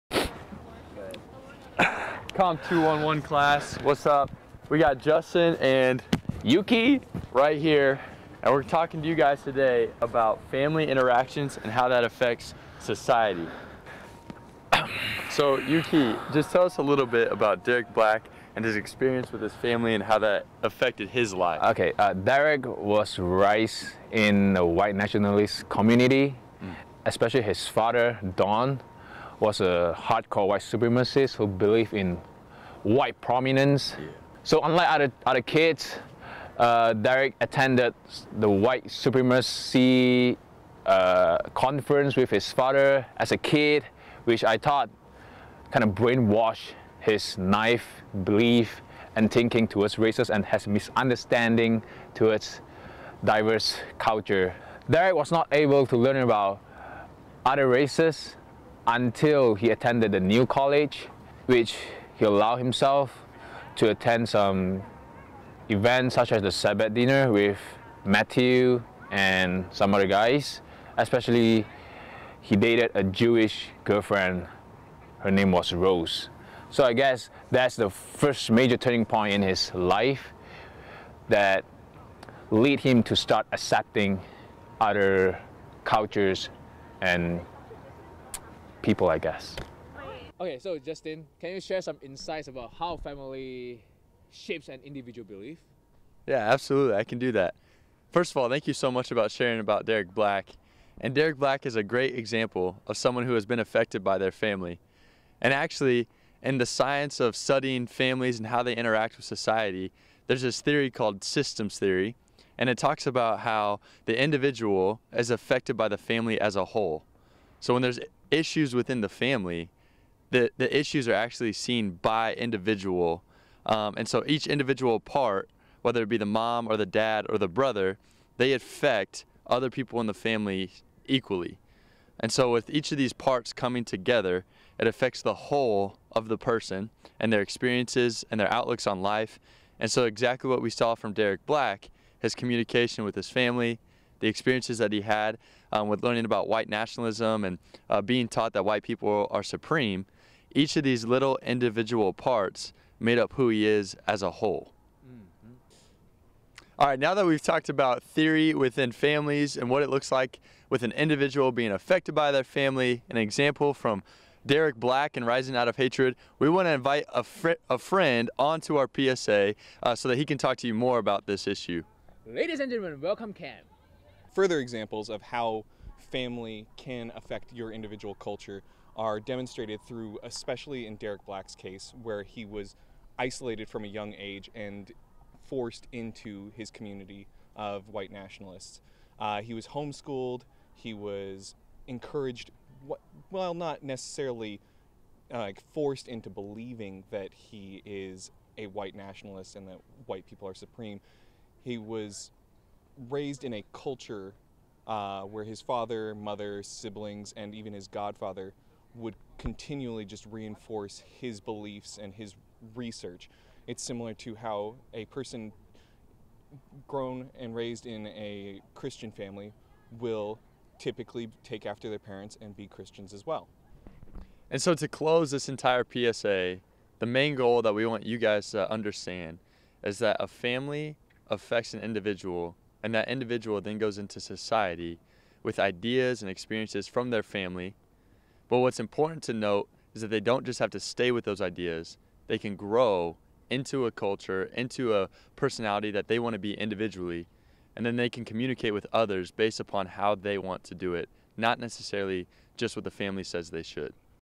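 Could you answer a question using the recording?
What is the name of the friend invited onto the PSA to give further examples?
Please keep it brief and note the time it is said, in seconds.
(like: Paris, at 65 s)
Cam, at 173 s.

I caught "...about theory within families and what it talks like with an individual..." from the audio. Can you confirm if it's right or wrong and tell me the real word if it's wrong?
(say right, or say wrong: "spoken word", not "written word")
wrong: "looks", not "talks".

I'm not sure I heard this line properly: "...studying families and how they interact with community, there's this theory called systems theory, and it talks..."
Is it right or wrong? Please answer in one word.
wrong.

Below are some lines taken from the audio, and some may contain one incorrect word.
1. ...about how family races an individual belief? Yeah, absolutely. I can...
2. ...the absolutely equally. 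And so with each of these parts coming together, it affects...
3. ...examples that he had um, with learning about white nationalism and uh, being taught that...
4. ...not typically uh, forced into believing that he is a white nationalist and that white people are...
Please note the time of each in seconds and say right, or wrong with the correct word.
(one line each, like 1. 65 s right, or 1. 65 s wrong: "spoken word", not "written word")
1. 92 s wrong: "shapes", not "races"
2. 130 s wrong: "family", not "absolutely"
3. 144 s wrong: "experiences", not "examples"
4. 193 s wrong: "necessarily", not "typically".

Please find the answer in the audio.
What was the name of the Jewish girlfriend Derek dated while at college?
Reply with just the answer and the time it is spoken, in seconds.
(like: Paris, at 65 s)
Rose, at 75 s.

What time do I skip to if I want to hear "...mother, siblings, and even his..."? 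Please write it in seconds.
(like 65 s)
206 s.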